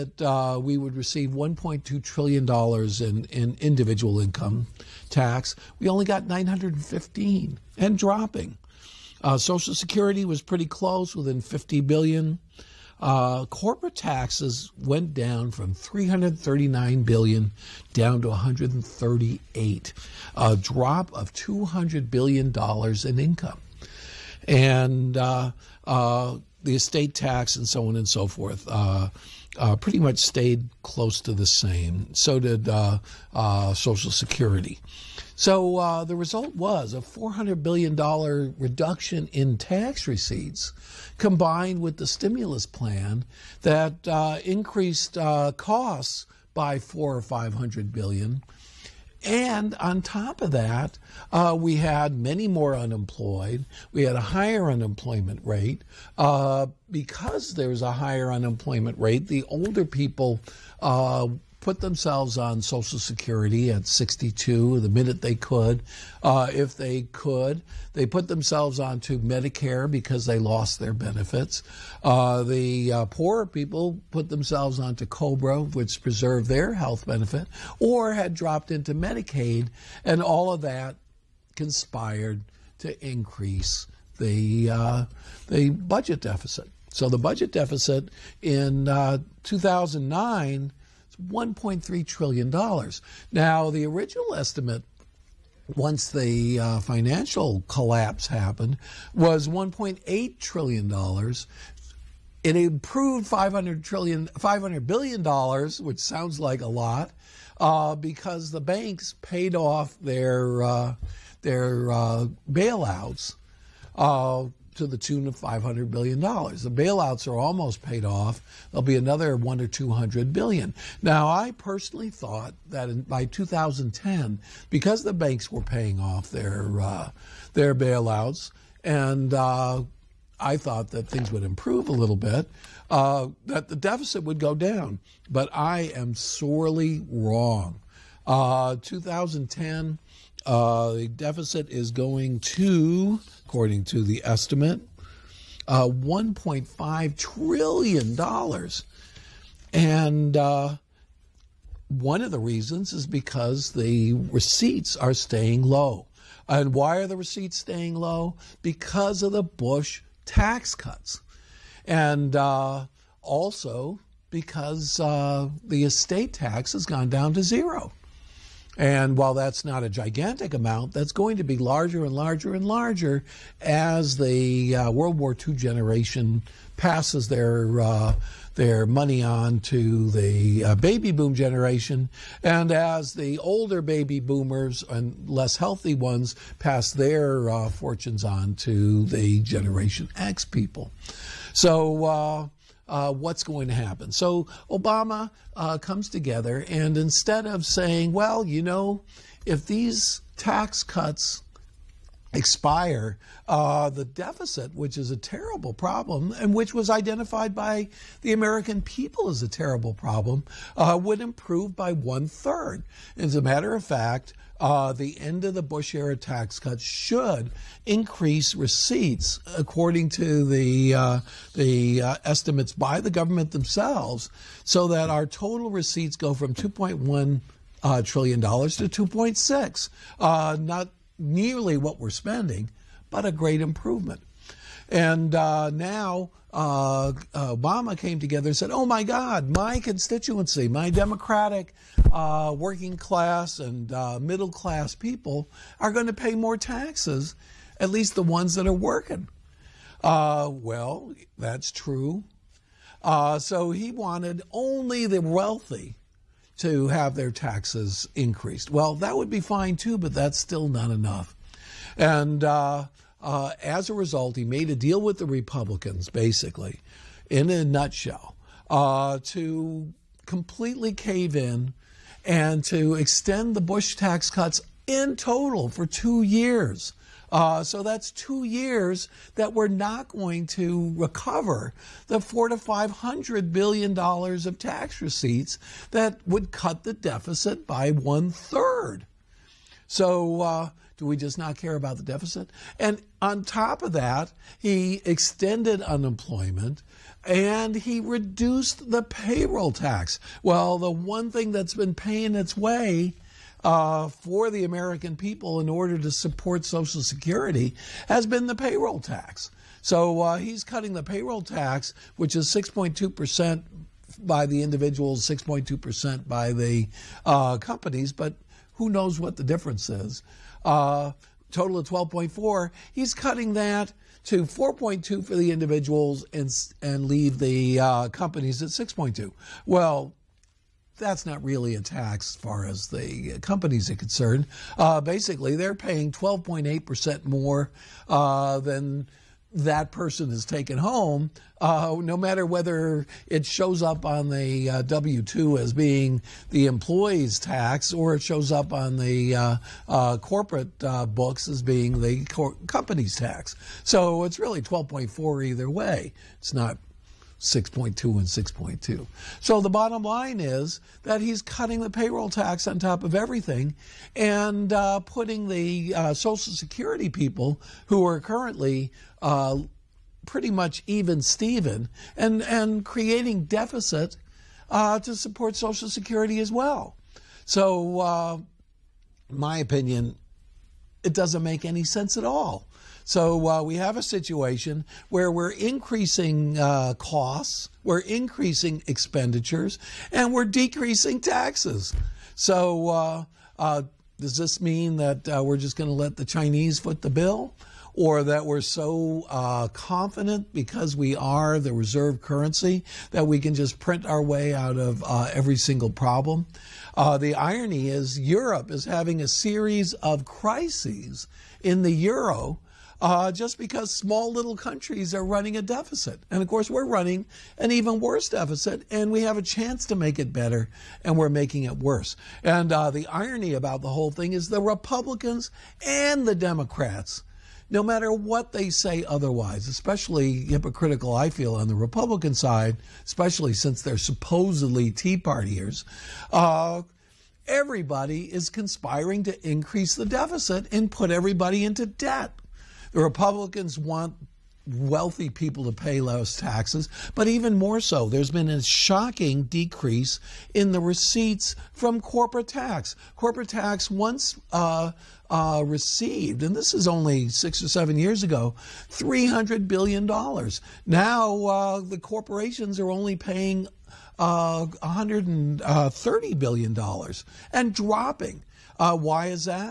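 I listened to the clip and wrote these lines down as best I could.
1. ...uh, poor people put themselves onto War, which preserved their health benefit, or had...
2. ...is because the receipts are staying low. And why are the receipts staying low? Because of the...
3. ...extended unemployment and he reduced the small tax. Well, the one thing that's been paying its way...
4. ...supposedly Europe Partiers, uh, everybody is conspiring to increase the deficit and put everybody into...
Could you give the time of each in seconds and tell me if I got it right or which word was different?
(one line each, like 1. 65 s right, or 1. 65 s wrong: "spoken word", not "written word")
1. 72 s wrong: "COBRA", not "War"
2. 152 s right
3. 295 s wrong: "payroll", not "small"
4. 433 s wrong: "Tea", not "Europe".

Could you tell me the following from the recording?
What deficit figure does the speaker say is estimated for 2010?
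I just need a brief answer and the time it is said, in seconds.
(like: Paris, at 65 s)
$1.5 trillion, at 145 s.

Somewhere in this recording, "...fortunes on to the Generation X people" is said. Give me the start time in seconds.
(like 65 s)
187 s.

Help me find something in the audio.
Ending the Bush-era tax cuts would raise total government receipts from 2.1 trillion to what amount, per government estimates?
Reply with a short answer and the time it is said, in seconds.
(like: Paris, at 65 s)
2.6 trillion, at 228 s.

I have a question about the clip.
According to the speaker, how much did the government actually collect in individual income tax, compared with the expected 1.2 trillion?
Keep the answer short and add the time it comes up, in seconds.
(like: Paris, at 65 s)
915 billion, at 6 s.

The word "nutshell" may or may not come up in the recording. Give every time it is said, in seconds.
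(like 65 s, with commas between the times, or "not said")
267 s.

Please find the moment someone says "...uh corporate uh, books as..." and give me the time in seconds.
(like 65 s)
349 s.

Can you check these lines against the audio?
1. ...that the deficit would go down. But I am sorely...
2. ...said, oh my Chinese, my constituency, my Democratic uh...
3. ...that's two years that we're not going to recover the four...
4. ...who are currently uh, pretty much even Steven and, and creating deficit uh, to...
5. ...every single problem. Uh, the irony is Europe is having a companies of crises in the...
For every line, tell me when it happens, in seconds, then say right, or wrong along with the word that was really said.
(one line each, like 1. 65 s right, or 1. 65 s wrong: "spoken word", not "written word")
1. 133 s right
2. 238 s wrong: "God", not "Chinese"
3. 277 s right
4. 367 s right
5. 405 s wrong: "series", not "companies".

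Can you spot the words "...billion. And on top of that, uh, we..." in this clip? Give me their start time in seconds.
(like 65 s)
47 s.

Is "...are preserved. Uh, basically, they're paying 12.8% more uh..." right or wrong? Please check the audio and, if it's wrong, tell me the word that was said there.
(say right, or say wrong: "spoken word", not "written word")
wrong: "concerned", not "preserved".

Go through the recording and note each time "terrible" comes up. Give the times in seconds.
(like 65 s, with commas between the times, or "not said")
205 s, 209 s.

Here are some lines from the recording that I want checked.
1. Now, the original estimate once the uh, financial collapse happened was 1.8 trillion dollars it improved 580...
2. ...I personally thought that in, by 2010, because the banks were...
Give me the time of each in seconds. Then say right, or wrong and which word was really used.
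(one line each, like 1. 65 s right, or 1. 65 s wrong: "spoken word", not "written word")
1. 93 s wrong: "500", not "580"
2. 121 s right.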